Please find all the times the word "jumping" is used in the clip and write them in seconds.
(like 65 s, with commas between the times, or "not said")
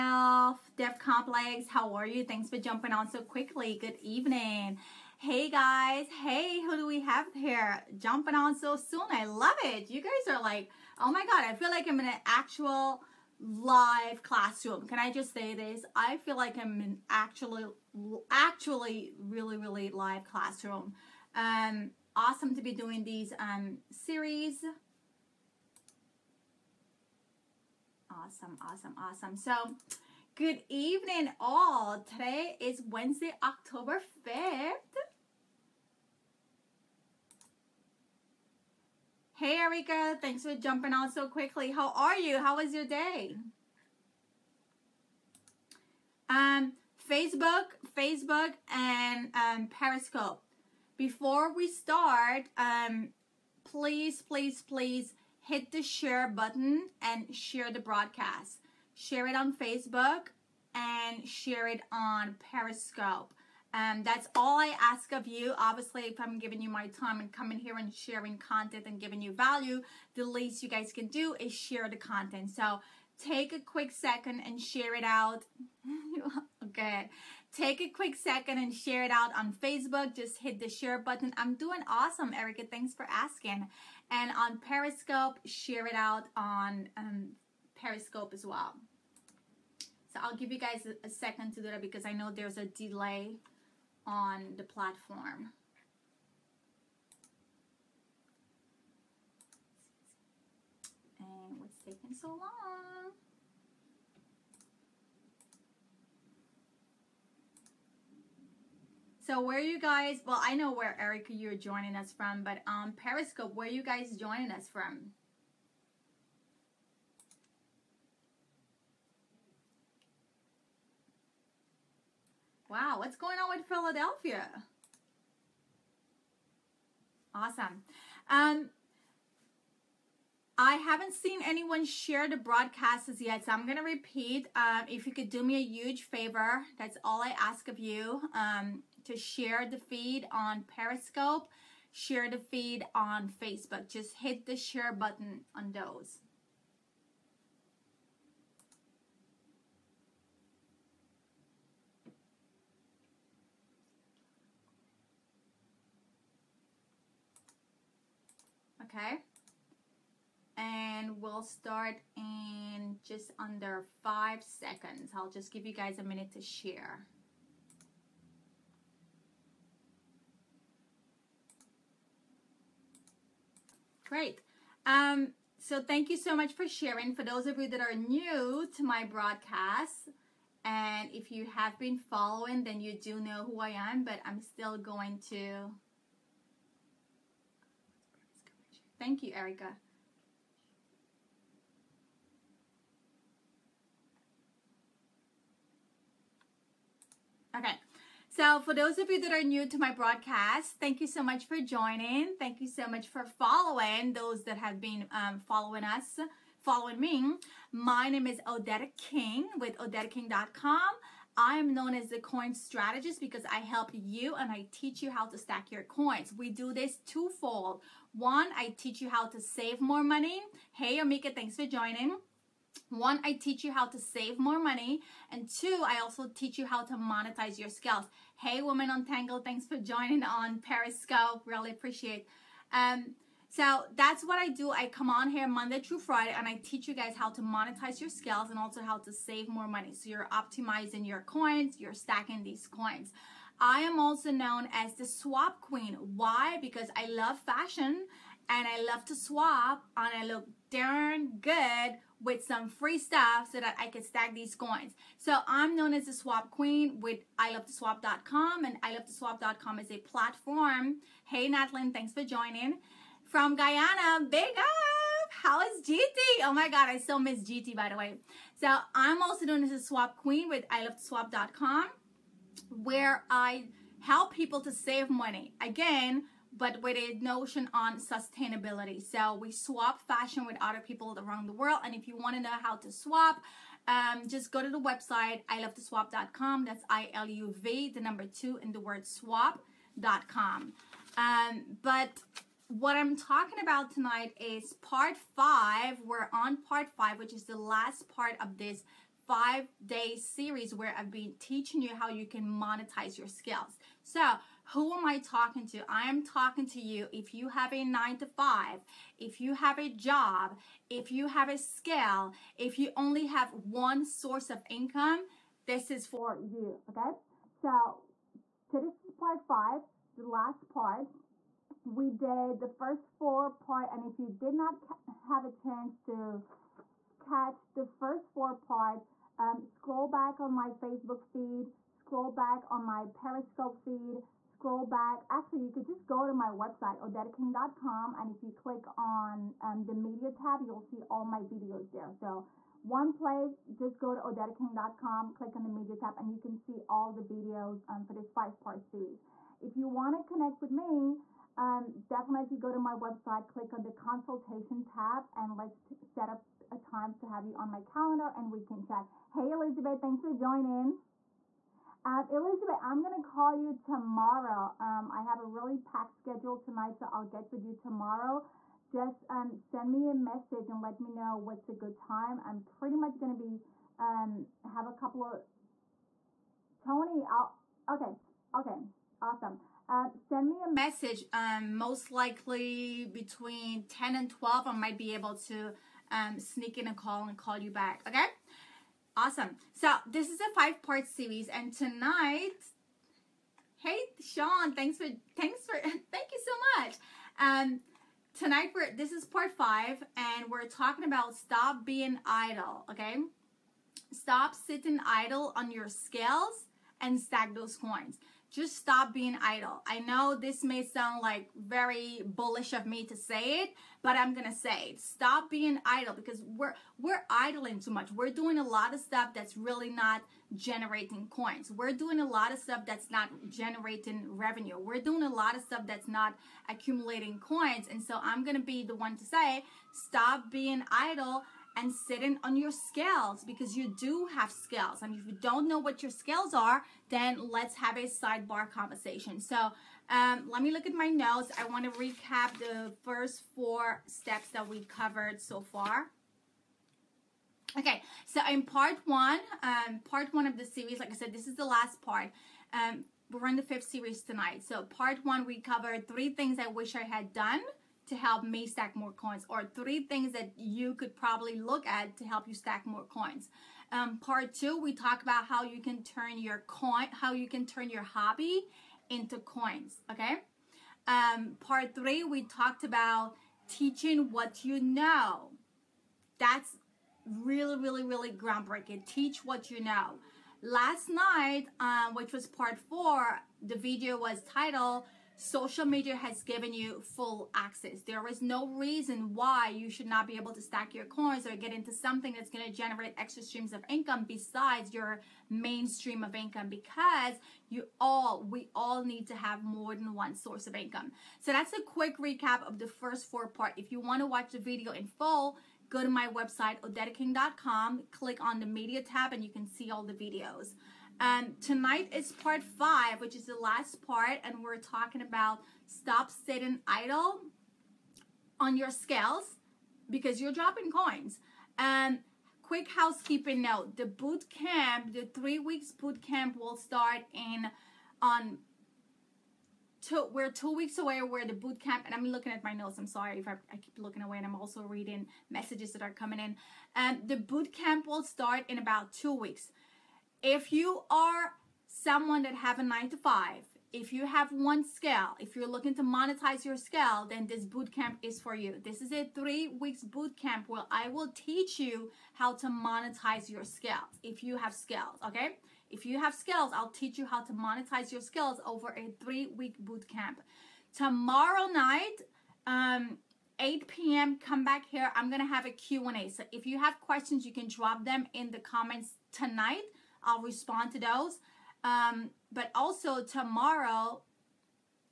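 2 s, 7 s, 40 s.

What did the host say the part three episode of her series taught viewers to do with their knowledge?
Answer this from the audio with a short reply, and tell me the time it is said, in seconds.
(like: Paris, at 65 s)
Teach what you know, at 473 s.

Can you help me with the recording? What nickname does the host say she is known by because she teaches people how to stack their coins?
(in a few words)
the coin strategist.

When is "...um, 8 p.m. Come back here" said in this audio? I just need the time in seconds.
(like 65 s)
562 s.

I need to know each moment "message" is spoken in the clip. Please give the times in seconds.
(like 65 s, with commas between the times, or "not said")
370 s, 380 s, 535 s.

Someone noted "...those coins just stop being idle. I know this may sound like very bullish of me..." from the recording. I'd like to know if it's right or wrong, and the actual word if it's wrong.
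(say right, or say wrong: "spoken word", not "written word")
right.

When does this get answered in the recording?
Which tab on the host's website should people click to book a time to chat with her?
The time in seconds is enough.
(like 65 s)
353 s.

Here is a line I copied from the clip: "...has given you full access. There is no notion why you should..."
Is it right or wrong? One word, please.
wrong.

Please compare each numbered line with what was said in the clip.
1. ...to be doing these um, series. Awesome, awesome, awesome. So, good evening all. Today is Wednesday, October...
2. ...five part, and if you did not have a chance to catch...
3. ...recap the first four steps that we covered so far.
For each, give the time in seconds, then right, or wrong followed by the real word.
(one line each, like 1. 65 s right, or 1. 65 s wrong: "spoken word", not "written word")
1. 22 s right
2. 323 s wrong: "four", not "five"
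3. 441 s right.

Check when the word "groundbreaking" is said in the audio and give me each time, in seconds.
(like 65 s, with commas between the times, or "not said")
478 s.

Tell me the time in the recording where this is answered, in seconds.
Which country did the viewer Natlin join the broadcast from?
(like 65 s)
263 s.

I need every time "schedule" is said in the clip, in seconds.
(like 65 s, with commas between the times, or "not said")
366 s.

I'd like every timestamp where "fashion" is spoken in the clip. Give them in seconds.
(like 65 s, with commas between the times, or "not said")
247 s, 280 s.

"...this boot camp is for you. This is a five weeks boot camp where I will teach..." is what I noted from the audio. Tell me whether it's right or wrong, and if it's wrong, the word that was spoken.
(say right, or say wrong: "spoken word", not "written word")
wrong: "three", not "five".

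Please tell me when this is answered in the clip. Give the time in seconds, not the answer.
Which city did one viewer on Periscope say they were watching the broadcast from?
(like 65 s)
123 s.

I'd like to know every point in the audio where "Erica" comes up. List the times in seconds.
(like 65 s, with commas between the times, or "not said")
39 s, 82 s, 110 s, 189 s.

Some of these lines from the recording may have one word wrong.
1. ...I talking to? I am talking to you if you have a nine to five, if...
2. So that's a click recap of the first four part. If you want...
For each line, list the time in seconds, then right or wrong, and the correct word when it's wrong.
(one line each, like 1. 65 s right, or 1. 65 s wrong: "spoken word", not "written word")
1. 305 s right
2. 501 s wrong: "quick", not "click".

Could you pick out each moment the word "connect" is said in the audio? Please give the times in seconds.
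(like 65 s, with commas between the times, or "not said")
350 s.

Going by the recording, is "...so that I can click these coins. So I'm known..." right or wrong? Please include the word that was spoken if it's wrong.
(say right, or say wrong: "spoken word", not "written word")
wrong: "stack", not "click".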